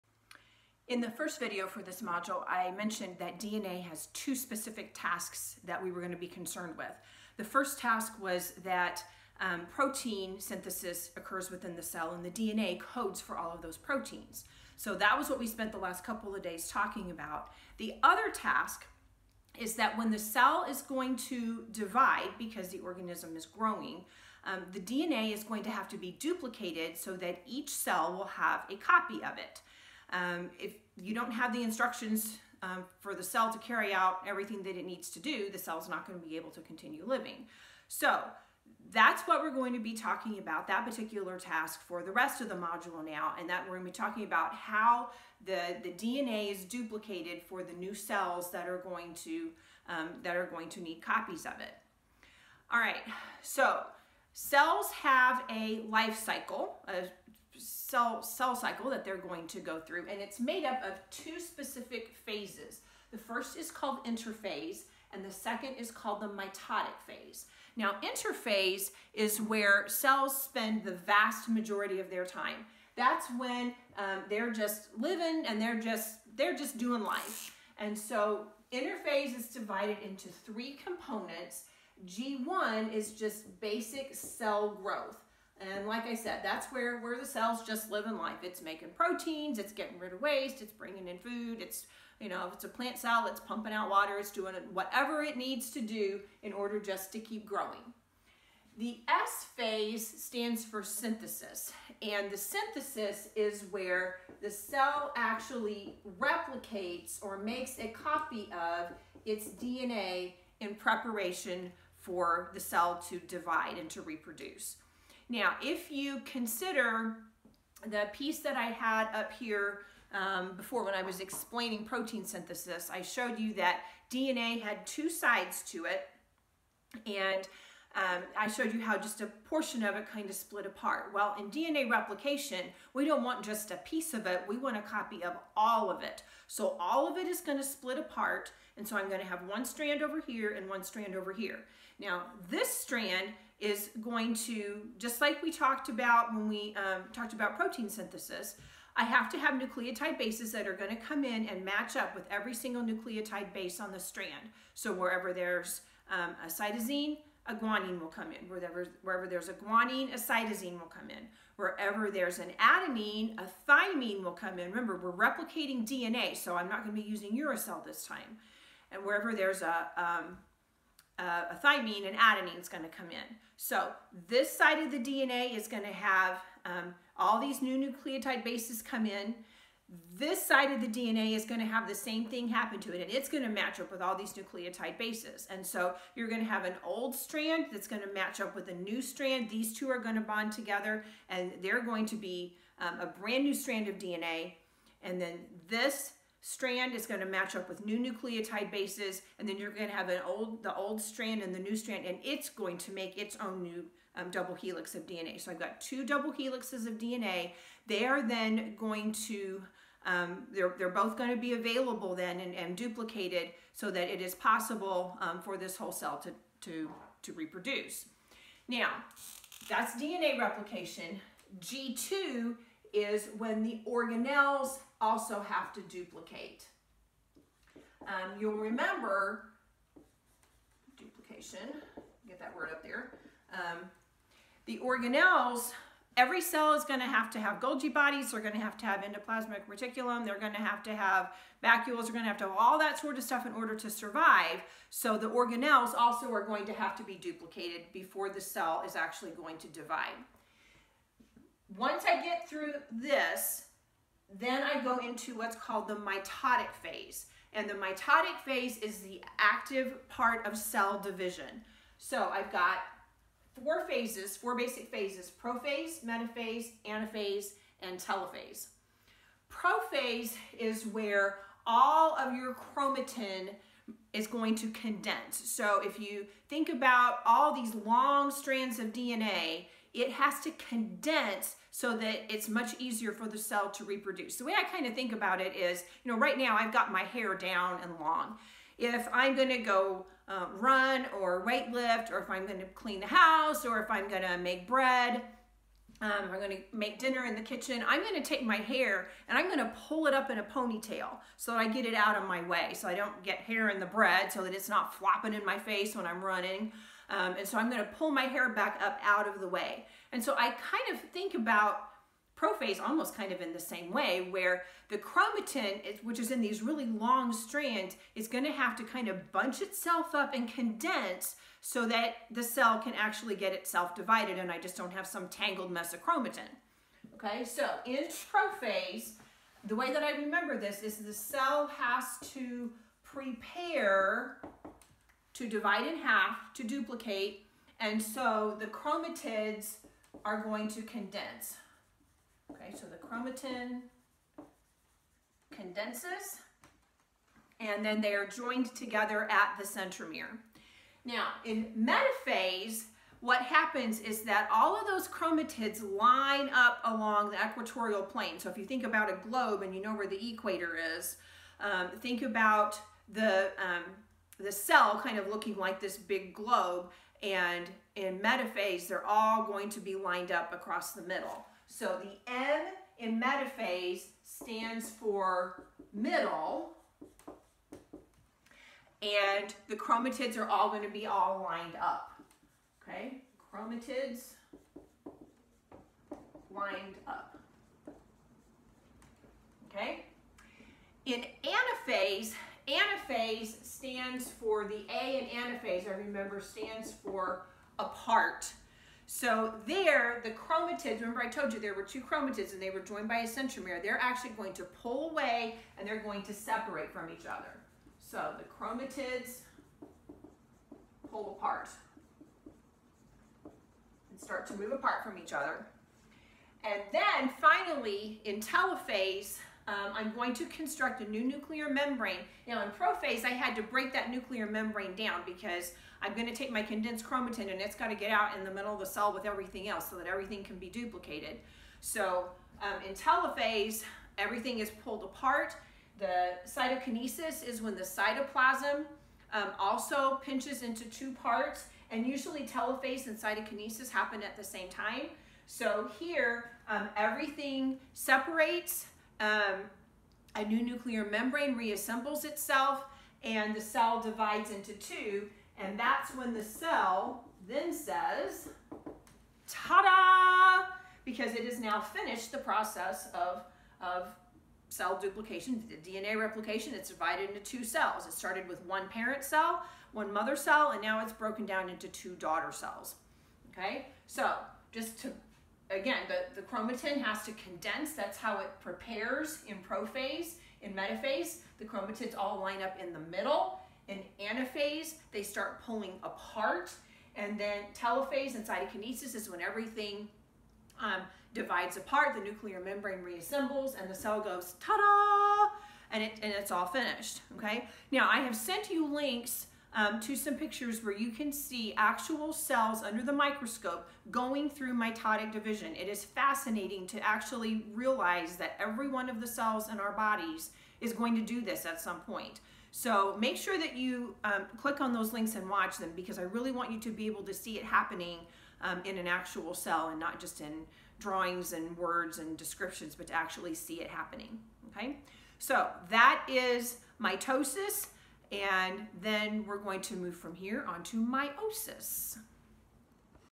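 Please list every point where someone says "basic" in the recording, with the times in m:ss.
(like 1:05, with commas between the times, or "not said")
1:23, 4:24.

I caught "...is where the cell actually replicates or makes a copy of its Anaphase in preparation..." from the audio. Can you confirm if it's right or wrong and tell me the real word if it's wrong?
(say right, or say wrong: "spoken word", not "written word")
wrong: "DNA", not "Anaphase".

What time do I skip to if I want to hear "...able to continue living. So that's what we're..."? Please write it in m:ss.
0:36.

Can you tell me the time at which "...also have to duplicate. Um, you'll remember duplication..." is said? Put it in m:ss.
3:45.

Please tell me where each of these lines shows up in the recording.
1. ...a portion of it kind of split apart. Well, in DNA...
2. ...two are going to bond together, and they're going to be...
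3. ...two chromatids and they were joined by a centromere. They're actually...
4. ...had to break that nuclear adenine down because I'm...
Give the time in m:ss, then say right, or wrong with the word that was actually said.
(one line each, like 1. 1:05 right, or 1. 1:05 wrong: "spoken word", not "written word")
1. 2:09 right
2. 3:09 right
3. 6:41 right
4. 7:03 wrong: "membrane", not "adenine".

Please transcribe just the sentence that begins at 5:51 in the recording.
Now, in metaphase, what happens is that all of those chromatids line up along the equatorial plane.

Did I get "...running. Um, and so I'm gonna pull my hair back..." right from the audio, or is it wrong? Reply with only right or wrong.
right.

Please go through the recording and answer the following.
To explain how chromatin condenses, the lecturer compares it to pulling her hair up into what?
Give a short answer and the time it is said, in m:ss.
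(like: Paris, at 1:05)
a ponytail, at 5:00.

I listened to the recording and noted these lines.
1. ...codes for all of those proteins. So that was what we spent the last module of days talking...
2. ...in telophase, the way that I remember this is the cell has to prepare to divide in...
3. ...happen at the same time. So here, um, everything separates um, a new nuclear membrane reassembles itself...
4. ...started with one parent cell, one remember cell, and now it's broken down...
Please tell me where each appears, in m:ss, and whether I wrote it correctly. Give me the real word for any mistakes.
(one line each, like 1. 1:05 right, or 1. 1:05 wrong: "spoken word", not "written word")
1. 0:12 wrong: "couple", not "module"
2. 5:27 wrong: "prophase", not "telophase"
3. 7:23 right
4. 7:48 wrong: "mother", not "remember".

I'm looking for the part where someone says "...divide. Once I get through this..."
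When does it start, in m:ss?
4:09.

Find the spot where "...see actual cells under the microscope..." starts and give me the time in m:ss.
8:21.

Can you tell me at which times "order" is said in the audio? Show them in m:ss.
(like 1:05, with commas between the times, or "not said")
1:36, 4:03.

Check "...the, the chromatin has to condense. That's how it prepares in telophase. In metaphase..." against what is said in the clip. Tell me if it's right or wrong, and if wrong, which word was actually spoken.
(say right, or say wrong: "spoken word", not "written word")
wrong: "prophase", not "telophase".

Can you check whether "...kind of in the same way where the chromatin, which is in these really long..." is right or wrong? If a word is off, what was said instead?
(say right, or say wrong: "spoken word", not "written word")
right.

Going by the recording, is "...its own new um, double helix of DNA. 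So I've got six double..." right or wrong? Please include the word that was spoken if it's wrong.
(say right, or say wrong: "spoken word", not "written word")
wrong: "two", not "six".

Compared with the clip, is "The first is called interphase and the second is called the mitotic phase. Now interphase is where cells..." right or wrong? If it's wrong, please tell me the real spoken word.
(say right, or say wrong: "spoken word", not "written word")
right.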